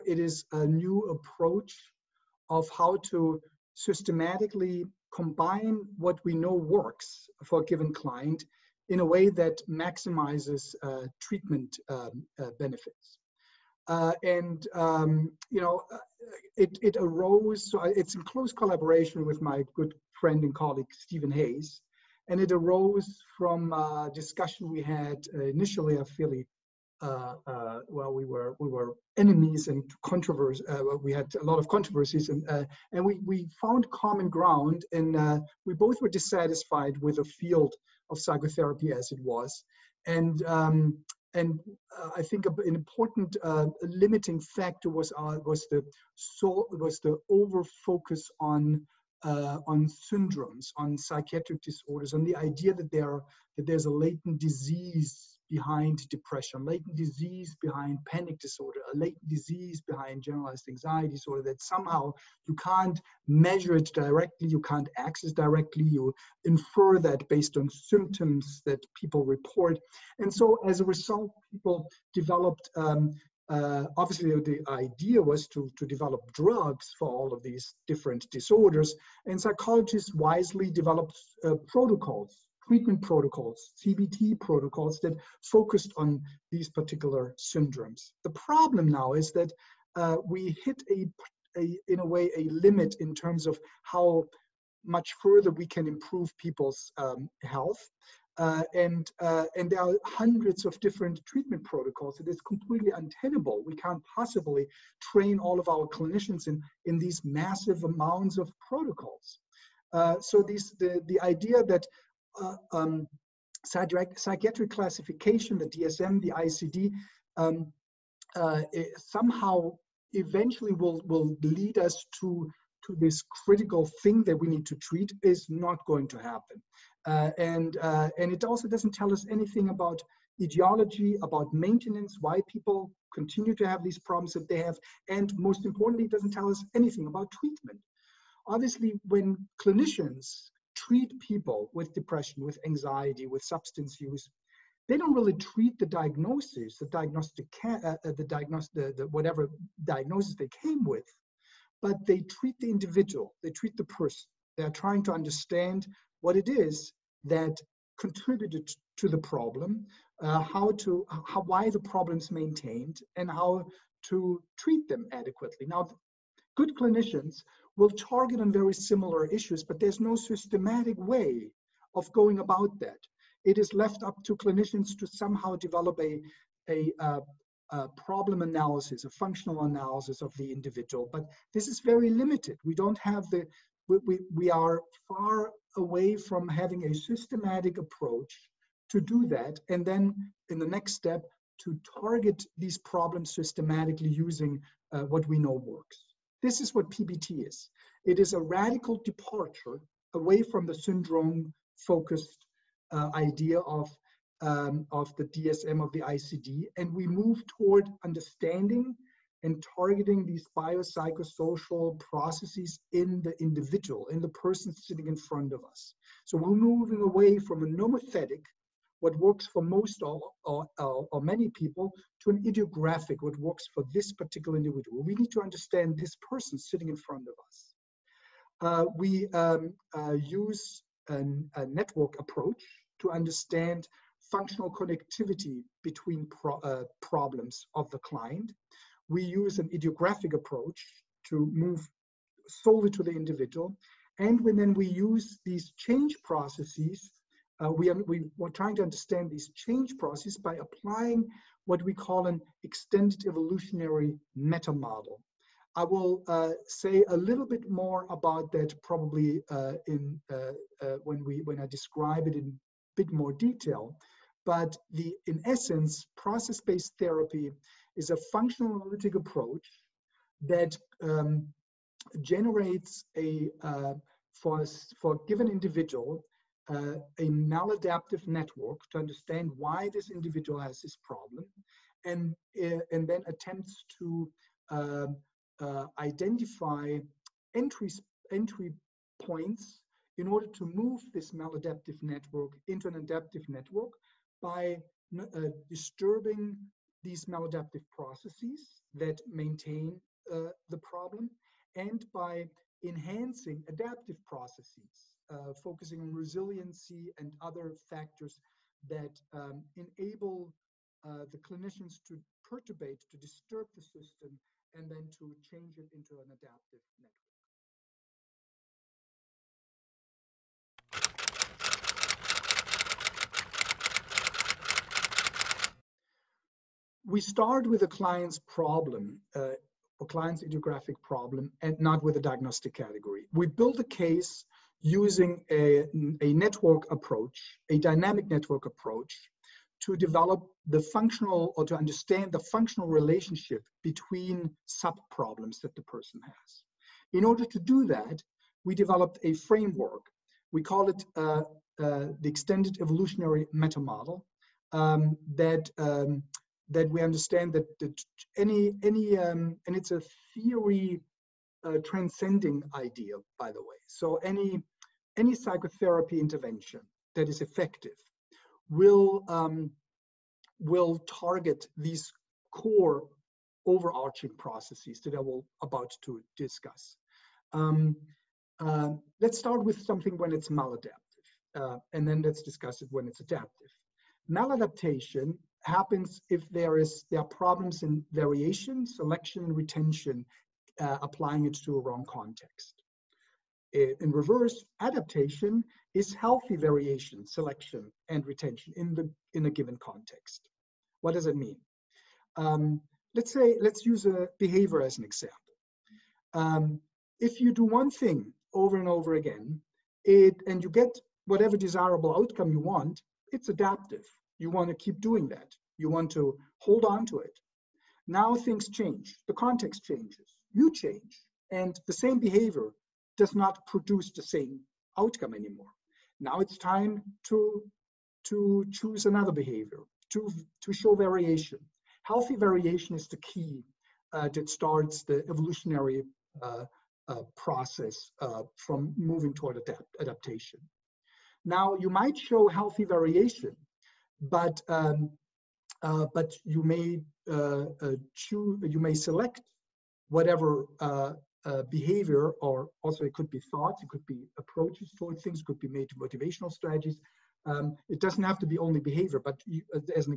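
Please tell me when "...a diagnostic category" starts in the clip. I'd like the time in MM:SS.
05:32.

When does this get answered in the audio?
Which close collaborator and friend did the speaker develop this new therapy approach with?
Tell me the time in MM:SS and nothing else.
00:20.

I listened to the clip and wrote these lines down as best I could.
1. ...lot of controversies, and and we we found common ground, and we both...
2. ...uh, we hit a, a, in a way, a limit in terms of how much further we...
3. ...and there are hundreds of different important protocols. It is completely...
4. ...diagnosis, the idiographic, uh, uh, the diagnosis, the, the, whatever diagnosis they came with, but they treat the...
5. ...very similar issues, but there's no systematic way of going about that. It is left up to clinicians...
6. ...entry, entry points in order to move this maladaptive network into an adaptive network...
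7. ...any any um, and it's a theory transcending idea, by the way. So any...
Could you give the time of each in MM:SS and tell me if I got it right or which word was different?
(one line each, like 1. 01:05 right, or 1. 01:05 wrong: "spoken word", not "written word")
1. 00:31 right
2. 01:29 right
3. 01:39 wrong: "treatment", not "important"
4. 02:25 wrong: "diagnostic", not "idiographic"
5. 02:48 right
6. 04:47 right
7. 05:58 right.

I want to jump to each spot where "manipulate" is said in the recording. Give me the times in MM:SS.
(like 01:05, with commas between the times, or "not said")
not said.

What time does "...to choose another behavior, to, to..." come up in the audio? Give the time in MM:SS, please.
07:08.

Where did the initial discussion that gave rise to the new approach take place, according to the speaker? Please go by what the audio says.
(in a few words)
Philly.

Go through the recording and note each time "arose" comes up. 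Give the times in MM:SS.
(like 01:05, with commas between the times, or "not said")
00:16, 00:22.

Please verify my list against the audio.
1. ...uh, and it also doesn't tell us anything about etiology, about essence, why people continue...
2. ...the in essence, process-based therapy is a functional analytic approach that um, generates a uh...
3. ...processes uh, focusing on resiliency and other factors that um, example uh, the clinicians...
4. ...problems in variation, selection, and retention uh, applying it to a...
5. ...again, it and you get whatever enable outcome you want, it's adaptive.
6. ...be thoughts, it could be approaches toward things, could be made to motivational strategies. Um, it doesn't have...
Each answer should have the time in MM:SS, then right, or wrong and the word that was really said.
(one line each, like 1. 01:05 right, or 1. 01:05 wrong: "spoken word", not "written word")
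1. 02:07 wrong: "maintenance", not "essence"
2. 04:24 right
3. 05:04 wrong: "enable", not "example"
4. 06:27 right
5. 06:49 wrong: "desirable", not "enable"
6. 07:33 right.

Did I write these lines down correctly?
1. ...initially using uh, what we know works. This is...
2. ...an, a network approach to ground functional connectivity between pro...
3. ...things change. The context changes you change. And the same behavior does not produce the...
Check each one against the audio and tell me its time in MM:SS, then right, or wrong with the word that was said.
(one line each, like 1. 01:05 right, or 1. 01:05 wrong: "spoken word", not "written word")
1. 03:13 wrong: "systematically", not "initially"
2. 03:51 wrong: "understand", not "ground"
3. 06:58 right.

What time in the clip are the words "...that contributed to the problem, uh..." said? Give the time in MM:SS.
02:37.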